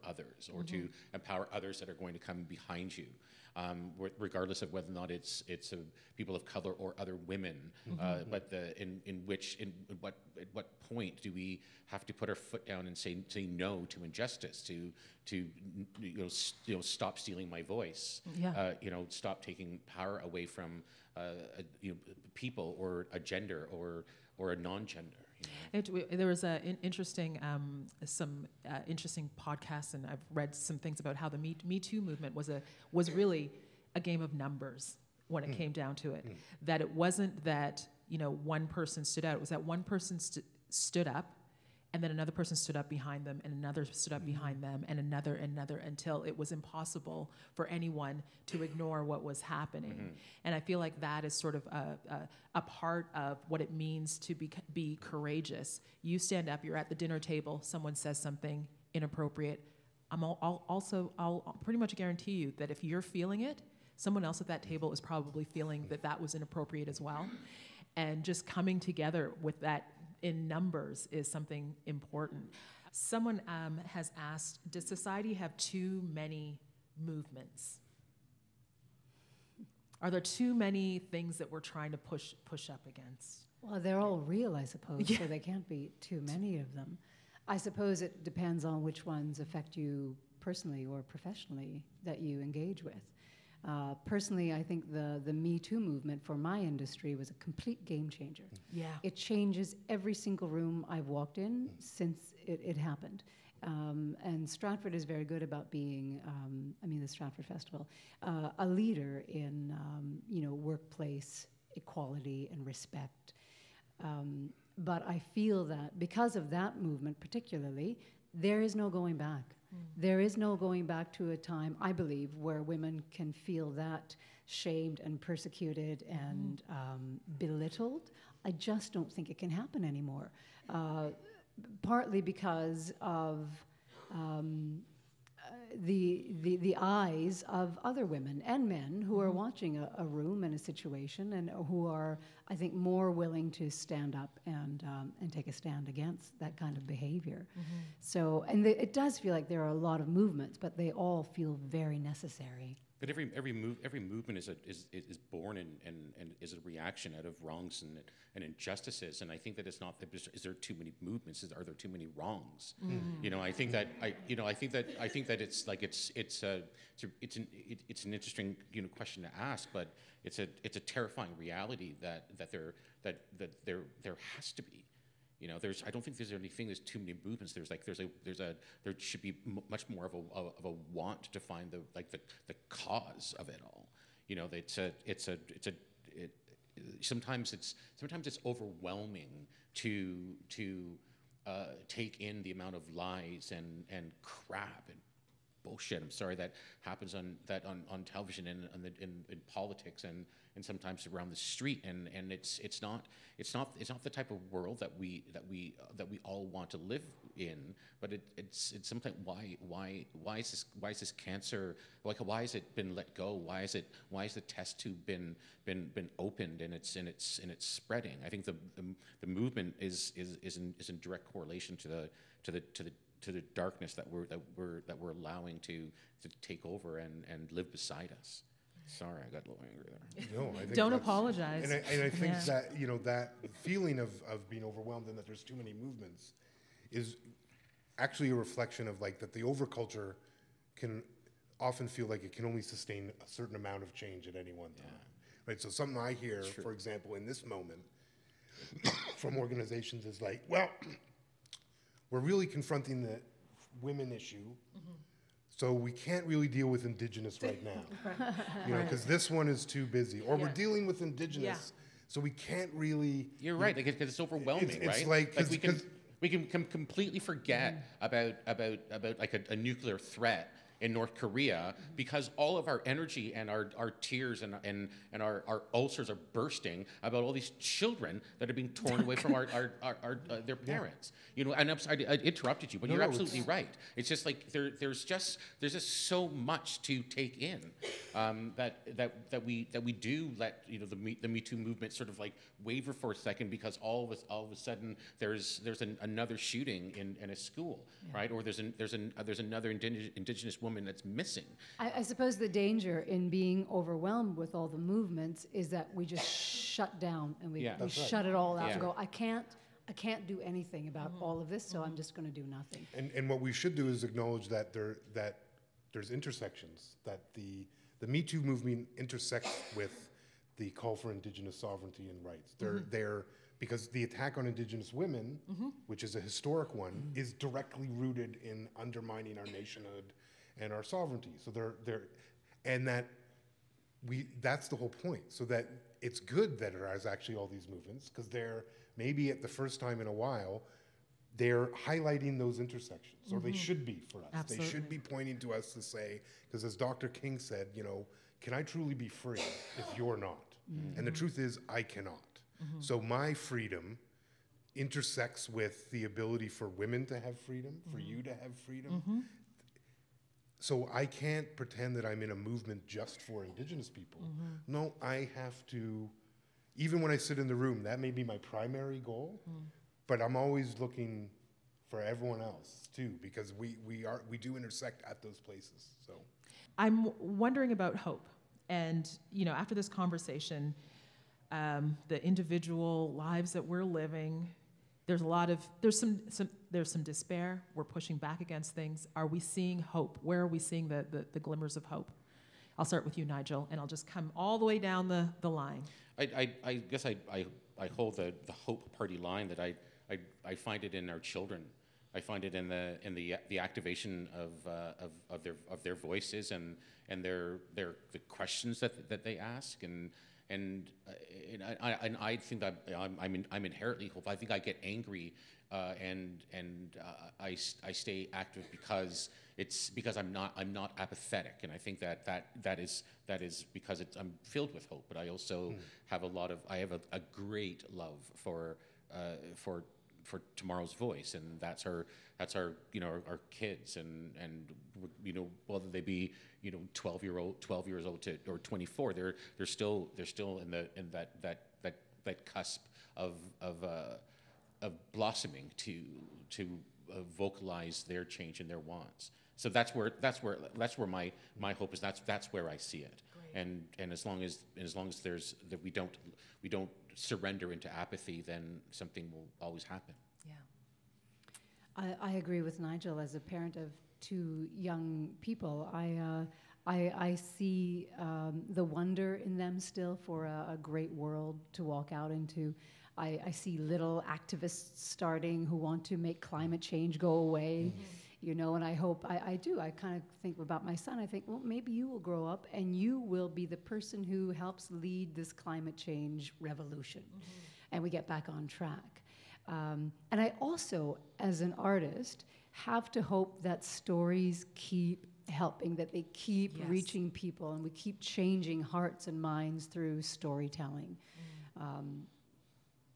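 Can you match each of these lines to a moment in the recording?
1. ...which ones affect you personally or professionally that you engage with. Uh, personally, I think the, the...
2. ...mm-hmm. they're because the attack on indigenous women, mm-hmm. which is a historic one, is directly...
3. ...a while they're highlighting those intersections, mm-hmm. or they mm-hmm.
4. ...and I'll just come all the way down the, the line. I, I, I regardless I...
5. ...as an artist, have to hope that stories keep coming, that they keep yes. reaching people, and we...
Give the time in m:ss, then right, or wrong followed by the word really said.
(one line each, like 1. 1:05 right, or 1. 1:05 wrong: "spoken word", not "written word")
1. 1:28 right
2. 5:22 right
3. 5:40 right
4. 6:33 wrong: "guess", not "regardless"
5. 8:11 wrong: "helping", not "coming".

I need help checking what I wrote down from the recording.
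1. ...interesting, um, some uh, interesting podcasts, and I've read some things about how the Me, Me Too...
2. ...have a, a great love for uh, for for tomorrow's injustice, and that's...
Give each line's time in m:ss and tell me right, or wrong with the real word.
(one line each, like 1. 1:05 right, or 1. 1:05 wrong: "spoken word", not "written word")
1. 0:26 right
2. 7:06 wrong: "voice", not "injustice".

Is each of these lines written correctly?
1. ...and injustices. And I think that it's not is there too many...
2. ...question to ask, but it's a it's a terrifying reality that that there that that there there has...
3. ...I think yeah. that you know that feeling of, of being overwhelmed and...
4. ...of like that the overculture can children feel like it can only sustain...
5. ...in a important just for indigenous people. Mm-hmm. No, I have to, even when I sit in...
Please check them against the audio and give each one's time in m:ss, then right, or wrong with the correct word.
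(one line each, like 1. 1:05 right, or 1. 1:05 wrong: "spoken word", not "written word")
1. 2:38 right
2. 2:48 right
3. 3:52 right
4. 3:58 wrong: "often", not "children"
5. 6:02 wrong: "movement", not "important".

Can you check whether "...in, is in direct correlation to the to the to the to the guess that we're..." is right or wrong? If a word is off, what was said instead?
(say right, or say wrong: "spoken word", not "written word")
wrong: "darkness", not "guess".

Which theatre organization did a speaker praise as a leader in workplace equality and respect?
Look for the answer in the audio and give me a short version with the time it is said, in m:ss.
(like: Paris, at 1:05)
Stratford Festival, at 1:47.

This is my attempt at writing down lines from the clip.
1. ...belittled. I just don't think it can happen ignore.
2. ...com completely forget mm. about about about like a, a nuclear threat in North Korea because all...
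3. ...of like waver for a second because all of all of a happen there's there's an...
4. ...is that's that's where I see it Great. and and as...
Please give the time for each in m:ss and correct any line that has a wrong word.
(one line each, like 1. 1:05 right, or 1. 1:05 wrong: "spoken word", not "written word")
1. 2:07 wrong: "anymore", not "ignore"
2. 4:26 right
3. 4:52 wrong: "sudden", not "happen"
4. 7:31 right.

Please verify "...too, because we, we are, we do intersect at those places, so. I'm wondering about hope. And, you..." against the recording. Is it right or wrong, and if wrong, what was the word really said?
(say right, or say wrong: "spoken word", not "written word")
right.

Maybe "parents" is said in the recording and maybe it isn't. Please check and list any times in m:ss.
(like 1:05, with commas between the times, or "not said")
4:40, 7:43.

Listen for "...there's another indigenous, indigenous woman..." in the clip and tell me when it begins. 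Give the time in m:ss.
4:59.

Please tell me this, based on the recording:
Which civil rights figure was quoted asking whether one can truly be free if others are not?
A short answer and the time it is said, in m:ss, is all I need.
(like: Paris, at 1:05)
Dr. King, at 5:46.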